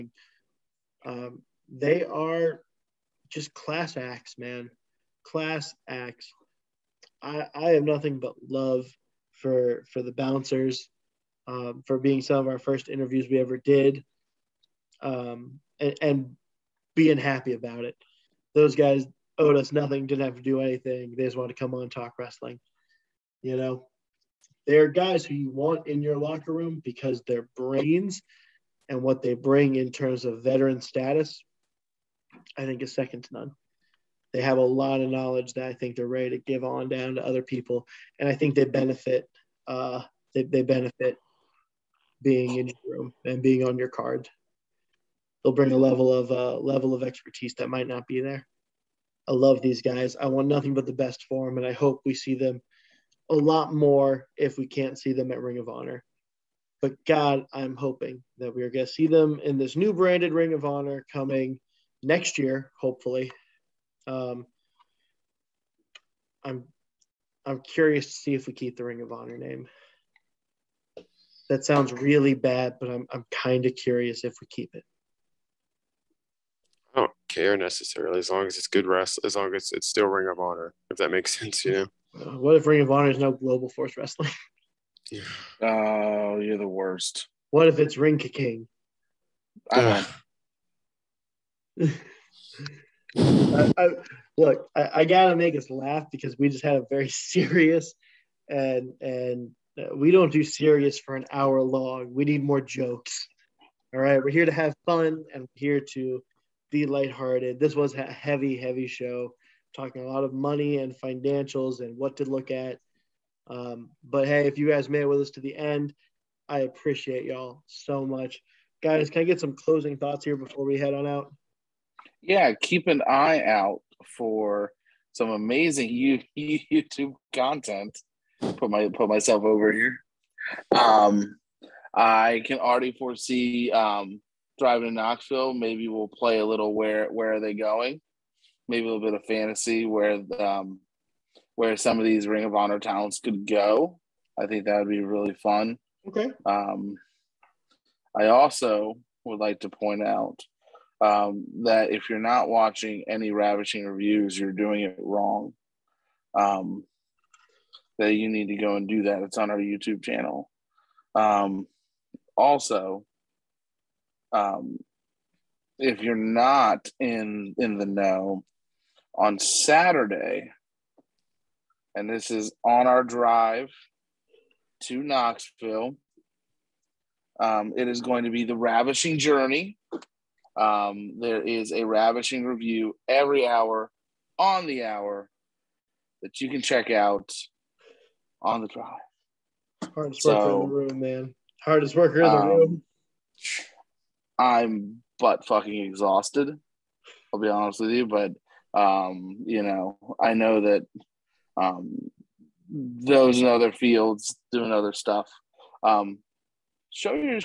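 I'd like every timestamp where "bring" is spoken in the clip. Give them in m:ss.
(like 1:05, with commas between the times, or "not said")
0:29, 0:45.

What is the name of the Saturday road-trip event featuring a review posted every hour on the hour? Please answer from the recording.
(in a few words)
The Ravishing Journey.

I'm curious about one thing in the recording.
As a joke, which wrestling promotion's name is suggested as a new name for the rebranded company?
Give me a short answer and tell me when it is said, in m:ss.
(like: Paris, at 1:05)
Global Force Wrestling, at 1:23.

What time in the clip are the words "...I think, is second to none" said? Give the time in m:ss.
0:32.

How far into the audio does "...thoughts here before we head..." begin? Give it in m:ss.
1:59.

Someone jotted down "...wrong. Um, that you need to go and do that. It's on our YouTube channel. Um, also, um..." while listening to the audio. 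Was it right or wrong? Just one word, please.
right.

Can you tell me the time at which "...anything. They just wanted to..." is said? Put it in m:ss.
0:20.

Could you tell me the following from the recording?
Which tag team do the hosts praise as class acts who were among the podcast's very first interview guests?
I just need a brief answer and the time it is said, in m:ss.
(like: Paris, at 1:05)
The Bouncers, at 0:10.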